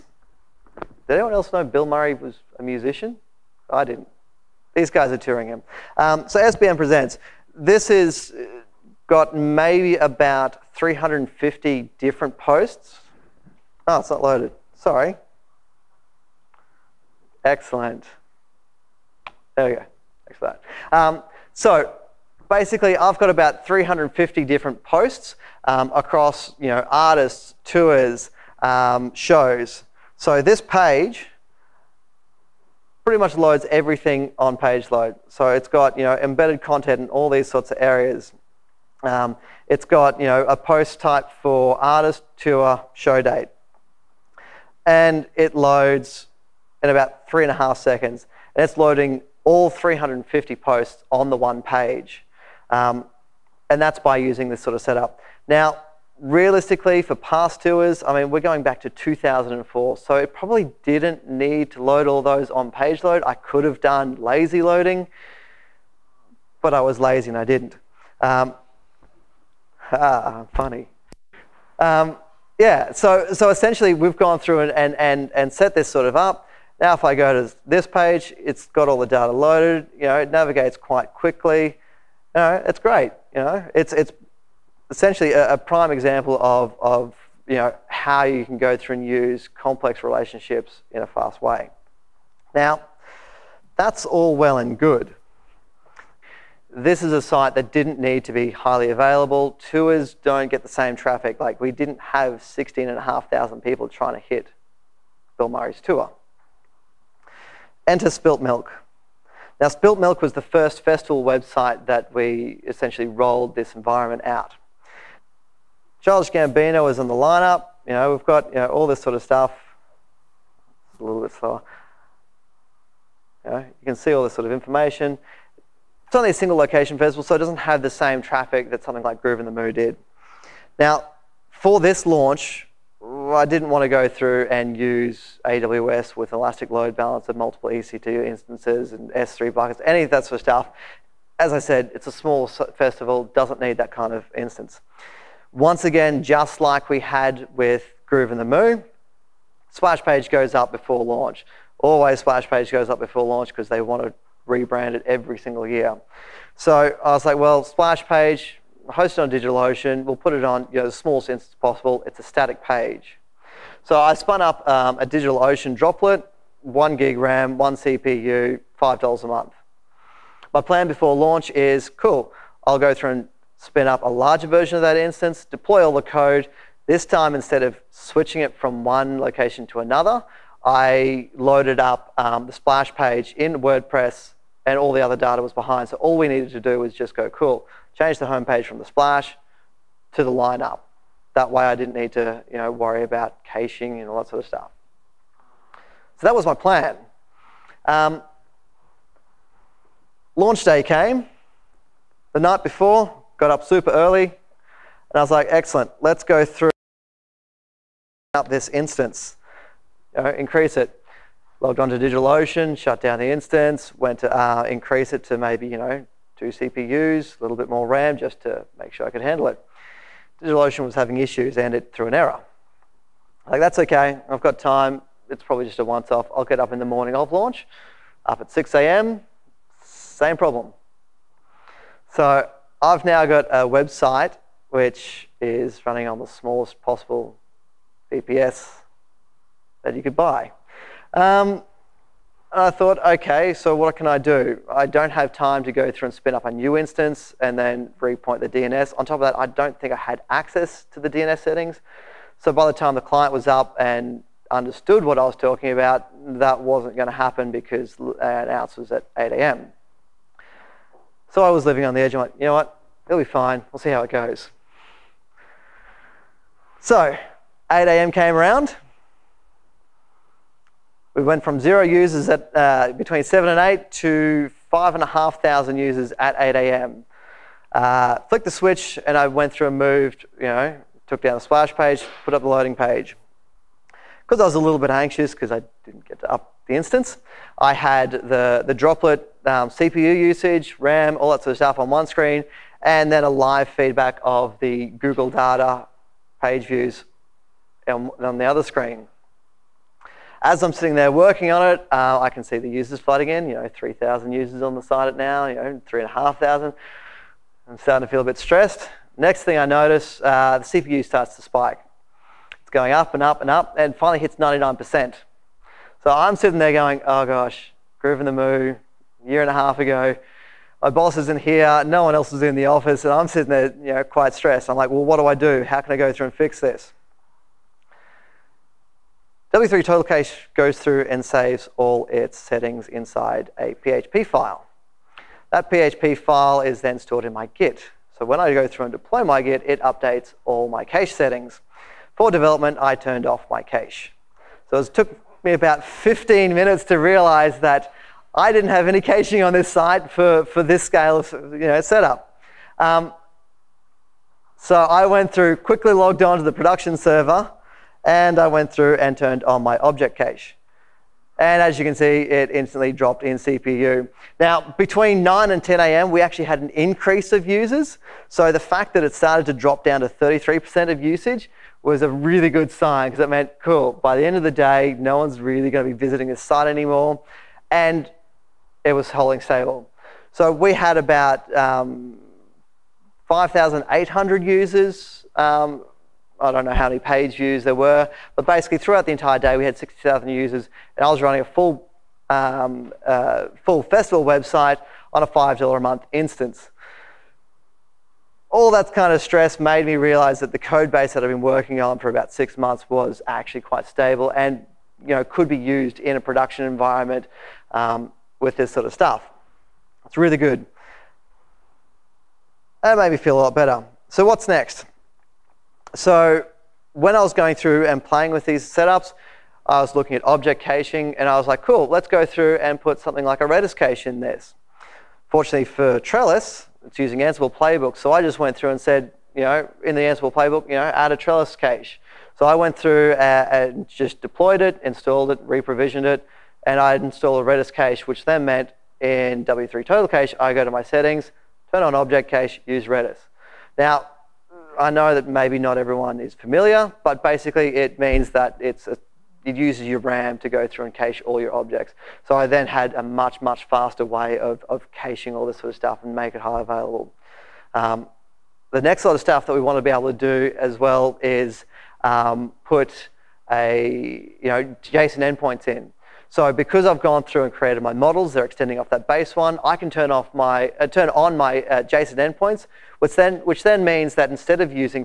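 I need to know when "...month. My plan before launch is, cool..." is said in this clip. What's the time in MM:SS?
02:49.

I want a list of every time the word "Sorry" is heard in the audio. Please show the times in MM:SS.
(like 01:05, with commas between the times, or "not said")
00:14.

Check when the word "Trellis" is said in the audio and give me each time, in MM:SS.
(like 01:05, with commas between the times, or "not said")
07:06, 07:11.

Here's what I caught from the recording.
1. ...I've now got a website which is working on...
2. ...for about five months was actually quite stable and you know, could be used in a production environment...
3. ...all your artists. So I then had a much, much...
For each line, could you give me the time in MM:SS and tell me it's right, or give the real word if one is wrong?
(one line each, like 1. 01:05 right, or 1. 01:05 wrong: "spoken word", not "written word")
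1. 03:52 wrong: "running", not "working"
2. 06:41 wrong: "six", not "five"
3. 07:31 wrong: "objects", not "artists".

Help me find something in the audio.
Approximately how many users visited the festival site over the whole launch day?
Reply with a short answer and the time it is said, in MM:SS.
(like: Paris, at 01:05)
60,000, at 06:29.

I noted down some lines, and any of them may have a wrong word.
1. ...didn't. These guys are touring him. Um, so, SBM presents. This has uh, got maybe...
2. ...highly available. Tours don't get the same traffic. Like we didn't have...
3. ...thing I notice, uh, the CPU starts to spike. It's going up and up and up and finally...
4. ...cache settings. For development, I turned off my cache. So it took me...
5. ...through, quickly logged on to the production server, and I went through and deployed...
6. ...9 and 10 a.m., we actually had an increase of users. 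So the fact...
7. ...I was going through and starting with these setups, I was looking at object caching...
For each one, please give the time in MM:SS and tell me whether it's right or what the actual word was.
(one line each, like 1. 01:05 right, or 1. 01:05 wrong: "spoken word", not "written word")
1. 00:03 right
2. 01:38 right
3. 05:09 right
4. 05:40 right
5. 05:55 wrong: "turned", not "deployed"
6. 06:05 right
7. 06:57 wrong: "playing", not "starting".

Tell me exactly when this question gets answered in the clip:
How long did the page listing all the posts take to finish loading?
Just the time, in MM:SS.
00:47.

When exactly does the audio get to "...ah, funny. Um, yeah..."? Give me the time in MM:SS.
01:09.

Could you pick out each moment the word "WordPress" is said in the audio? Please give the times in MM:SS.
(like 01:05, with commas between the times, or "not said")
03:03.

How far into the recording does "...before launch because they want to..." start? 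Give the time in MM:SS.
02:32.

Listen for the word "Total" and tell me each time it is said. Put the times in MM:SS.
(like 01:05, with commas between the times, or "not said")
05:29, 07:19.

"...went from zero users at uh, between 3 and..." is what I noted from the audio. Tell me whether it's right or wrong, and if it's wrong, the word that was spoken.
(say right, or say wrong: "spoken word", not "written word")
wrong: "7", not "3".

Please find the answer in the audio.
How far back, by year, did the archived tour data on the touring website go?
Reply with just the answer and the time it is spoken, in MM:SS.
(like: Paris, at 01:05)
2004, at 00:58.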